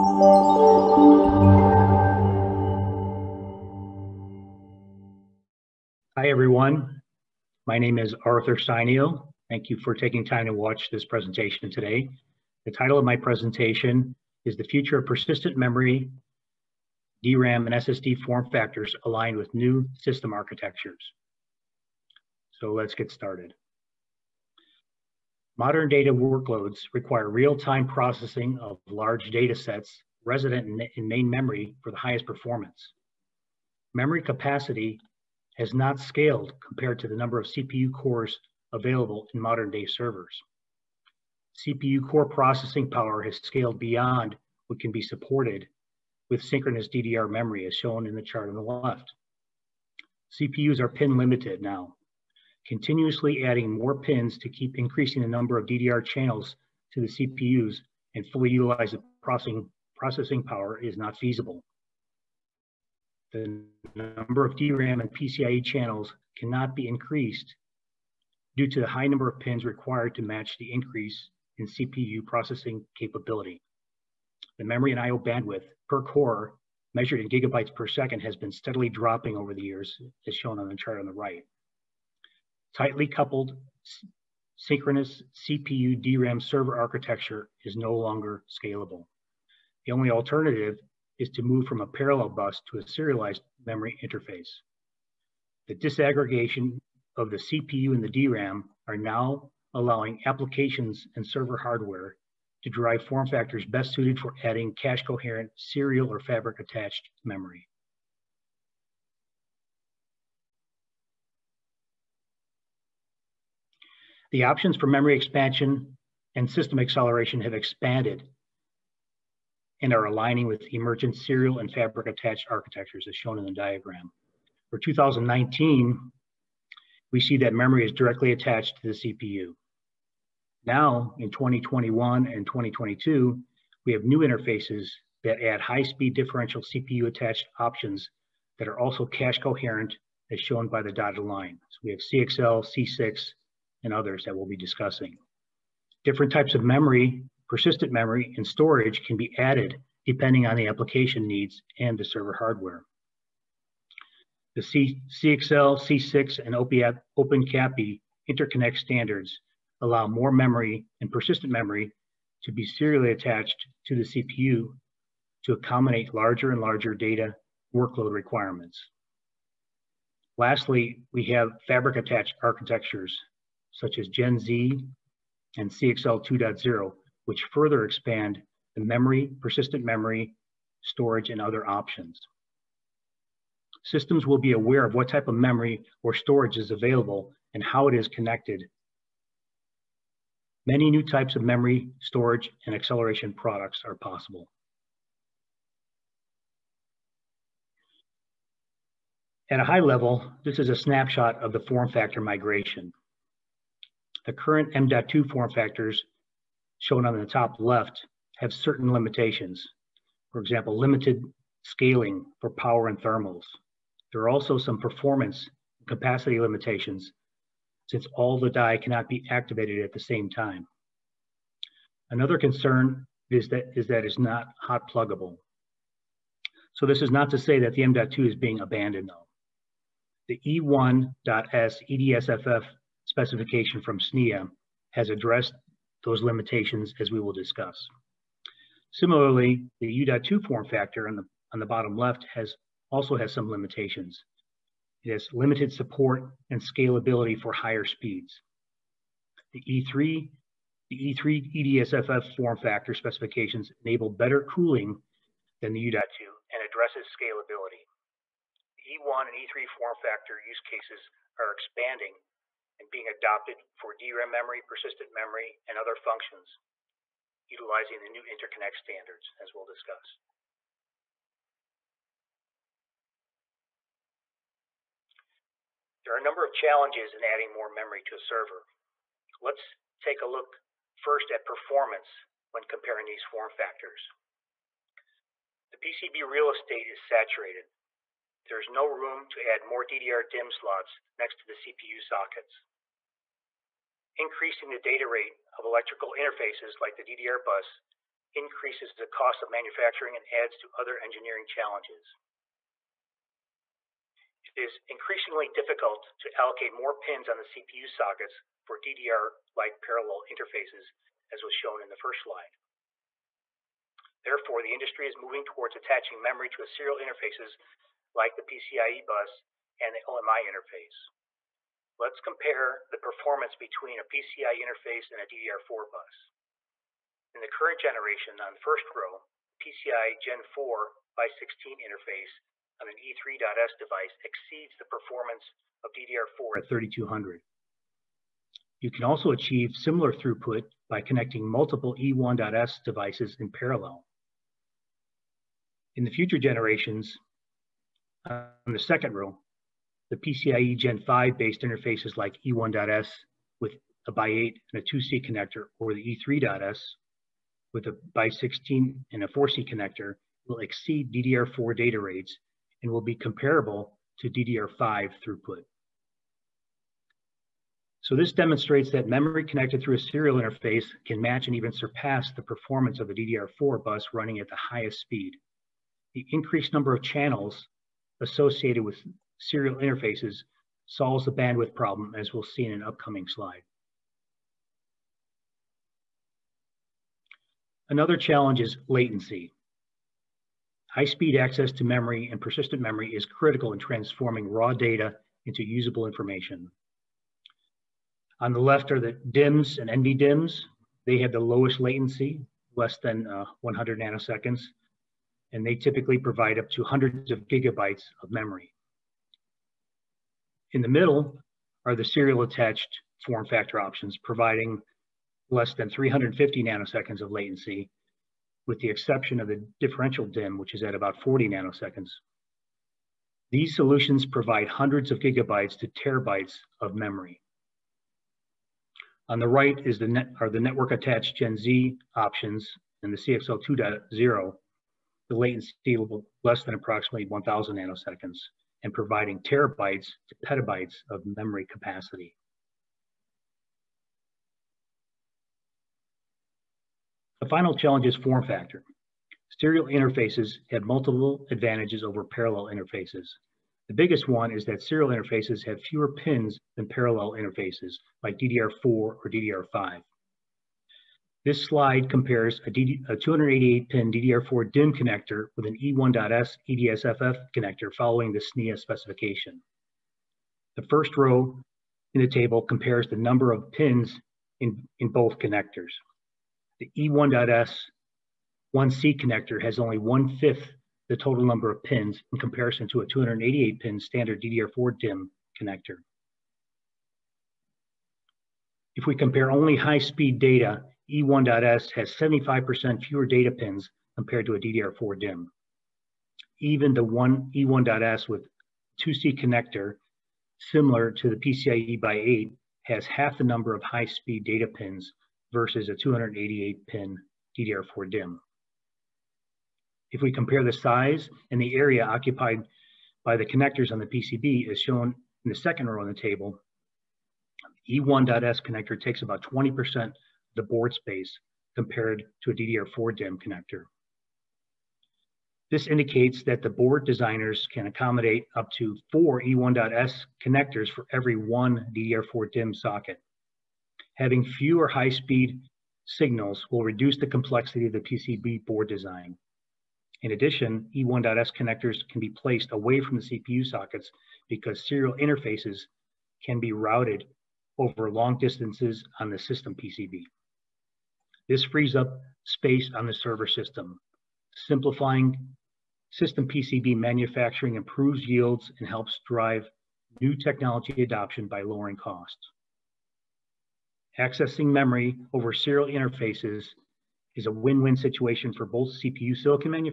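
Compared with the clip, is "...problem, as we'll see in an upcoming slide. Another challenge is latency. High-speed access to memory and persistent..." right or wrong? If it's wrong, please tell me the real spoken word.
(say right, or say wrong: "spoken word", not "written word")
right.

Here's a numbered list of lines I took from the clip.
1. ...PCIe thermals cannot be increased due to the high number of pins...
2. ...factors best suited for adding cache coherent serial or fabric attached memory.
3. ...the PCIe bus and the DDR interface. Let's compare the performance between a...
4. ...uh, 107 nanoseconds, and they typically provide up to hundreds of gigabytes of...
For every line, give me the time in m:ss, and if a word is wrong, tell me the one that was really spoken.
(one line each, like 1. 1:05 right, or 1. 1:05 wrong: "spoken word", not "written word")
1. 1:05 wrong: "channels", not "thermals"
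2. 1:43 right
3. 5:18 wrong: "OMI", not "DDR"
4. 6:43 wrong: "100", not "107".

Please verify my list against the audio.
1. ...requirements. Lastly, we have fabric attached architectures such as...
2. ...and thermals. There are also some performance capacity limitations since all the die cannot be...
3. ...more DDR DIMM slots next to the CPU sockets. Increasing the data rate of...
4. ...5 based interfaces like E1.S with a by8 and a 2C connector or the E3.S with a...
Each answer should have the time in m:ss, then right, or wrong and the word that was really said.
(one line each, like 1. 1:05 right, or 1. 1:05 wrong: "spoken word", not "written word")
1. 2:48 right
2. 3:32 right
3. 4:49 right
4. 5:51 right.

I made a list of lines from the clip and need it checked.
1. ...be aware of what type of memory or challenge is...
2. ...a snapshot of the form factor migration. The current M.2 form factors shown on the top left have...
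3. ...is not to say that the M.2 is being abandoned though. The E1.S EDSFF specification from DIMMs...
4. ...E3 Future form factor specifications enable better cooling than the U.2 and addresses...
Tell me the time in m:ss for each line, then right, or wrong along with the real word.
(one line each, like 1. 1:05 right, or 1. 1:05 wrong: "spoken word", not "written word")
1. 3:04 wrong: "storage", not "challenge"
2. 3:20 right
3. 3:47 wrong: "SNIA", not "DIMMs"
4. 4:11 wrong: "EDSFF", not "Future".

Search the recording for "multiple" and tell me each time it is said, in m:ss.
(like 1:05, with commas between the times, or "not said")
5:41, 7:30.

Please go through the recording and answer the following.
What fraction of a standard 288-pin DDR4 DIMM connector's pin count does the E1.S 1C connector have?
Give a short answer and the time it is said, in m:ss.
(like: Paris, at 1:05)
one-fifth, at 7:59.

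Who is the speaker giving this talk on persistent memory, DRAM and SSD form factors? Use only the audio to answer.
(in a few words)
Arthur Sainio.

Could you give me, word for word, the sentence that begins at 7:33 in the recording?
The biggest one is that serial interfaces have fewer pins than parallel interfaces like DDR4 or DDR5.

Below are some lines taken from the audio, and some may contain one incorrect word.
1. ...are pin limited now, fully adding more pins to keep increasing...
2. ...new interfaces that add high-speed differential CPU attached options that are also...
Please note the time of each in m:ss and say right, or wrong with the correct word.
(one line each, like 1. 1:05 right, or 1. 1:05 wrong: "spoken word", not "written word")
1. 0:50 wrong: "continuously", not "fully"
2. 2:14 right.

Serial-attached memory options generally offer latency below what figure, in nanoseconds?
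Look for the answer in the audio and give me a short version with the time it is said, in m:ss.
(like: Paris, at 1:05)
350, at 6:55.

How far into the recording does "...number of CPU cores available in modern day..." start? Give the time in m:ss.
0:37.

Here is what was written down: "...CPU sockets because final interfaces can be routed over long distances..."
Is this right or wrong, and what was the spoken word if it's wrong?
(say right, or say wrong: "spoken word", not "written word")
wrong: "serial", not "final".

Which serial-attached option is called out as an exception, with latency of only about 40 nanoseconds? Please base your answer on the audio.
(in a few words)
differential DIMM.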